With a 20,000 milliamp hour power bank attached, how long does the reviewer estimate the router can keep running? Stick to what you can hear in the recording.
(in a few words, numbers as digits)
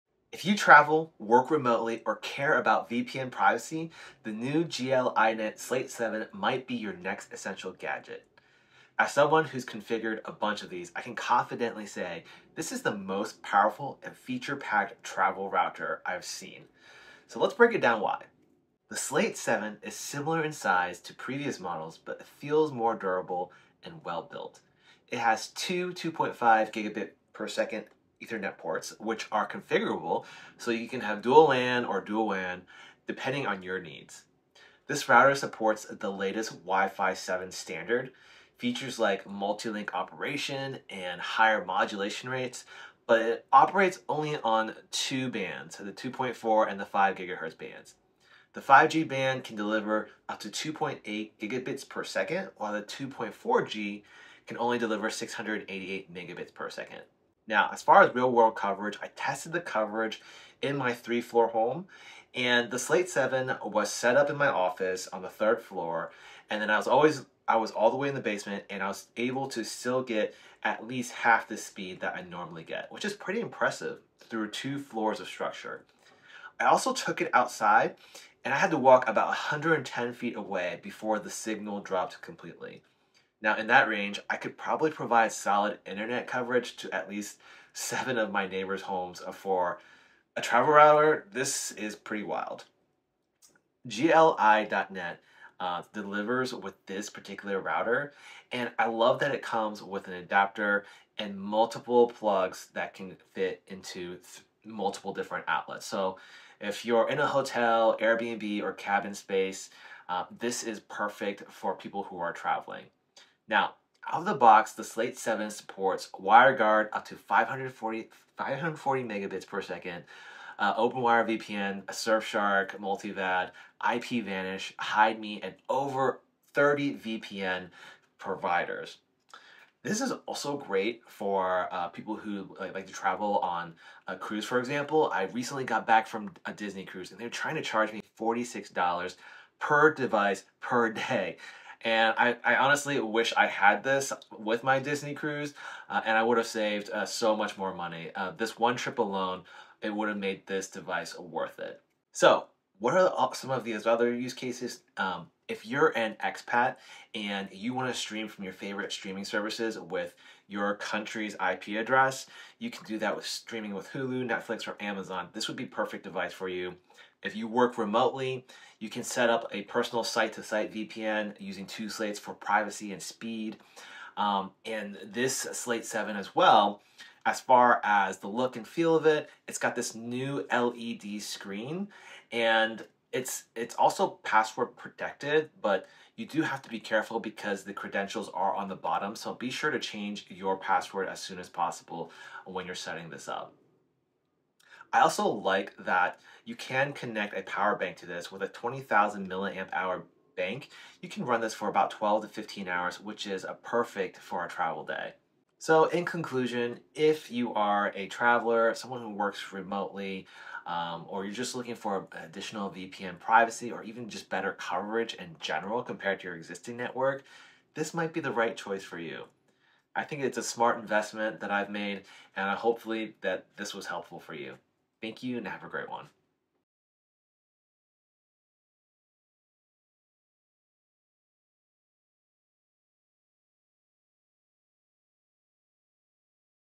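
12 to 15 hours.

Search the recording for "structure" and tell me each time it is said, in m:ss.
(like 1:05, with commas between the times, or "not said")
1:15.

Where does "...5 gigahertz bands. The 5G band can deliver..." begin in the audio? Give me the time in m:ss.
0:46.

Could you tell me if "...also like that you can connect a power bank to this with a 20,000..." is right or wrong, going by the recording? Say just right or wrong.
right.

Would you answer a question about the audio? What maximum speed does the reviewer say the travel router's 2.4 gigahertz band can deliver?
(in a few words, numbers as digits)
688 megabits per second.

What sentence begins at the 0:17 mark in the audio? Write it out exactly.
So let's break it down why.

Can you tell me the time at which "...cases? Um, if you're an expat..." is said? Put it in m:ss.
2:34.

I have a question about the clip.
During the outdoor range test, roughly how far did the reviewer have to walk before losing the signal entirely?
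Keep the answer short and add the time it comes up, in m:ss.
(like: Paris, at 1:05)
110 feet, at 1:19.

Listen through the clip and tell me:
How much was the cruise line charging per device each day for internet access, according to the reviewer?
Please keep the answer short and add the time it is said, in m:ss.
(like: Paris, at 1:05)
$46, at 2:18.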